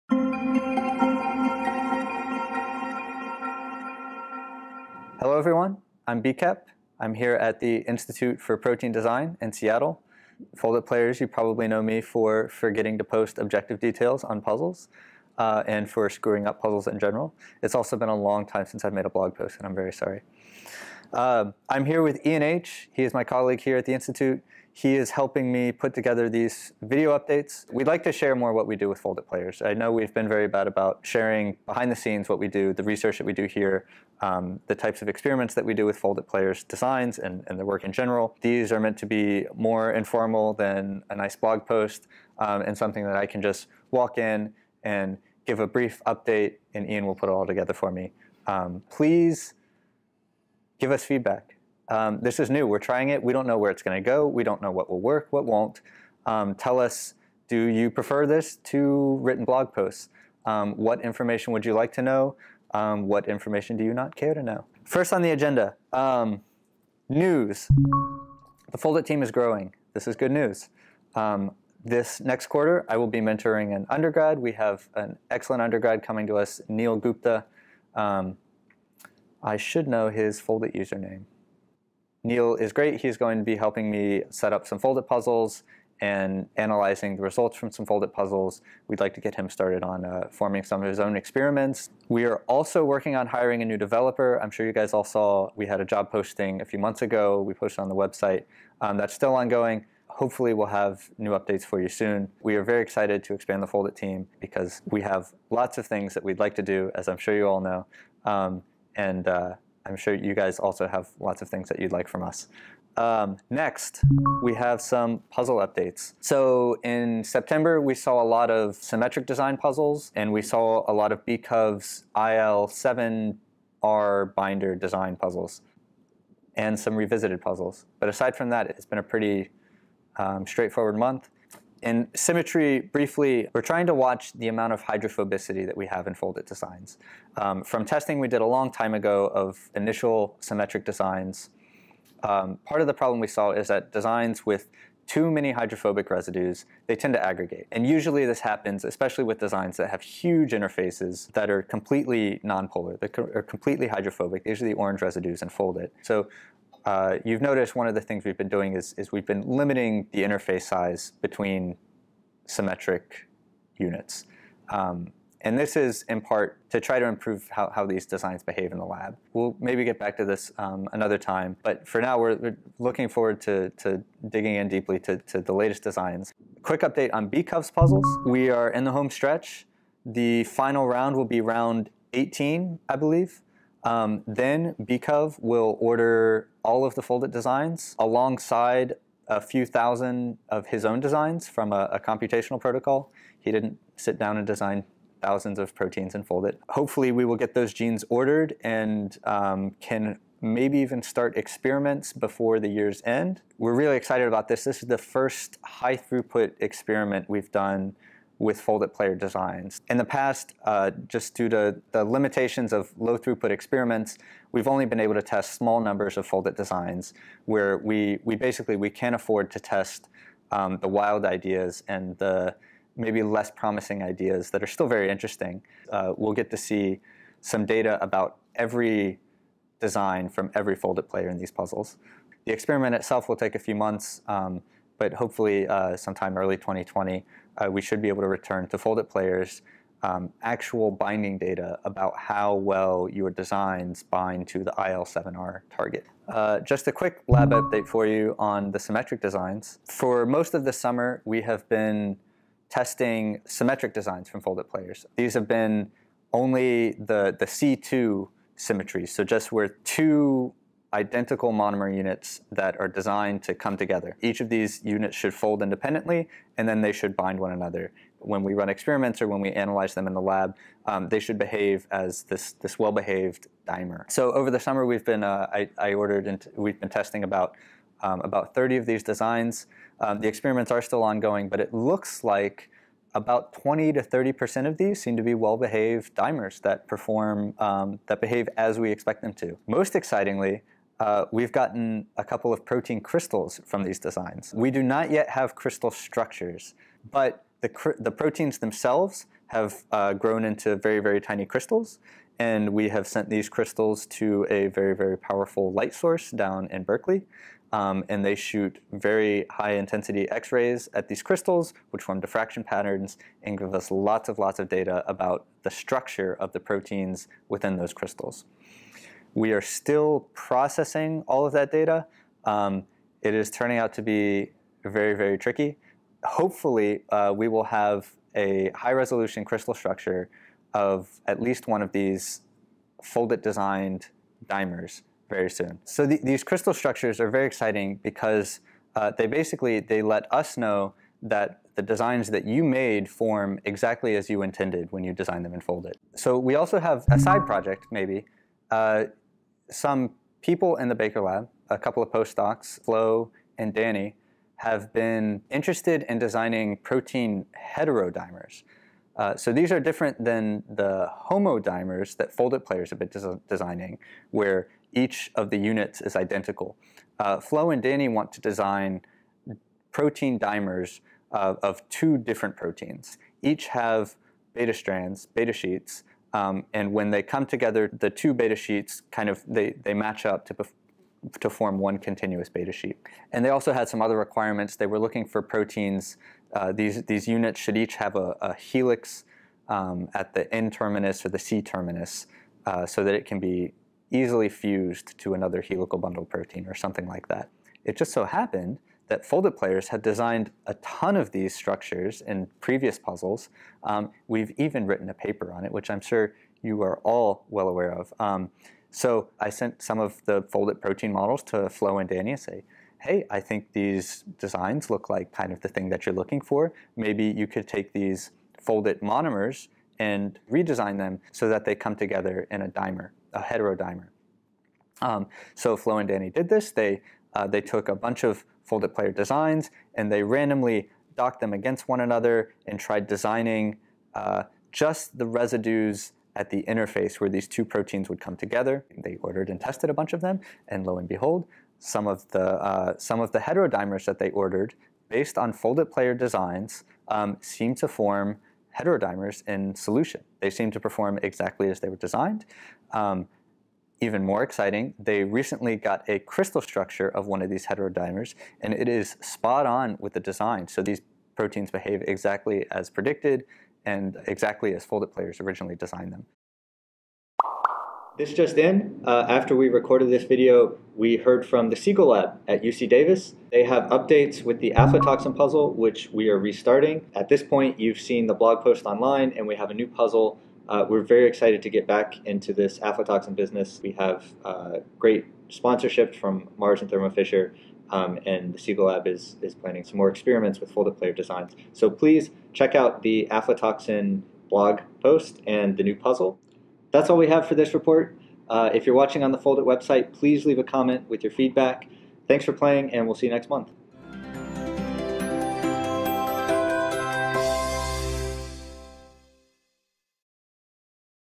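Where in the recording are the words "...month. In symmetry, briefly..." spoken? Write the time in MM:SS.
02:10.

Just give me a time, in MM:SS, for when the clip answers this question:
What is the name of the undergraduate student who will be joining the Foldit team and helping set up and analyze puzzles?
01:16.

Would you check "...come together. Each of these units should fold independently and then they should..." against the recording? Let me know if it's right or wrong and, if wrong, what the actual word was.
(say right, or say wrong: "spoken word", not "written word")
right.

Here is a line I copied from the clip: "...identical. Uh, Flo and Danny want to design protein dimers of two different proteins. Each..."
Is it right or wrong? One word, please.
right.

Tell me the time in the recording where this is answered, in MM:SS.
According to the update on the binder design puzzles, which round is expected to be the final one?
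03:01.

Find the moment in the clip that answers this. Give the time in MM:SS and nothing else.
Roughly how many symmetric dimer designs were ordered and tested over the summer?
04:38.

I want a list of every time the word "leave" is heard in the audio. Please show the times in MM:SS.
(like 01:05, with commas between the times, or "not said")
08:20.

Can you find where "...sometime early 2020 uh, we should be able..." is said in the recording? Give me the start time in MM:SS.
03:55.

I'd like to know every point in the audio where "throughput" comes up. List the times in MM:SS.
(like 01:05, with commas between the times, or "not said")
03:25, 03:33.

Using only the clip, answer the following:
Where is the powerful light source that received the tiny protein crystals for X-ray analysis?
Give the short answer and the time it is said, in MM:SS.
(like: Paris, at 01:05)
Berkeley, at 05:06.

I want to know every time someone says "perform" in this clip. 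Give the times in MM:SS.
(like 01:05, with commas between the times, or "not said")
04:46, 07:30.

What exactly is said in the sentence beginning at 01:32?
We are also working on hiring a new developer.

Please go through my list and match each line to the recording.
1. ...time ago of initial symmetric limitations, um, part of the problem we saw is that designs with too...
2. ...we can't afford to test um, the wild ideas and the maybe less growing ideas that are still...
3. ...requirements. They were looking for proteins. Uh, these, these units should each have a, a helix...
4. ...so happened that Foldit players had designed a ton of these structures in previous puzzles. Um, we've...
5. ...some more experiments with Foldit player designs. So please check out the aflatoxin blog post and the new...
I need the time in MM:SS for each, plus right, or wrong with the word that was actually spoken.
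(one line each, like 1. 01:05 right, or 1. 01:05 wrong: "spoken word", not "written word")
1. 02:18 wrong: "designs", not "limitations"
2. 03:38 wrong: "promising", not "growing"
3. 06:24 right
4. 06:38 right
5. 08:09 right.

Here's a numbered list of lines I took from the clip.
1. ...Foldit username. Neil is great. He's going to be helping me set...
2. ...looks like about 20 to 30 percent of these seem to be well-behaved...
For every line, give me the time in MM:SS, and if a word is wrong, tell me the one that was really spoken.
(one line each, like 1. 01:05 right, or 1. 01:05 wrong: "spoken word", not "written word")
1. 01:20 right
2. 04:41 right.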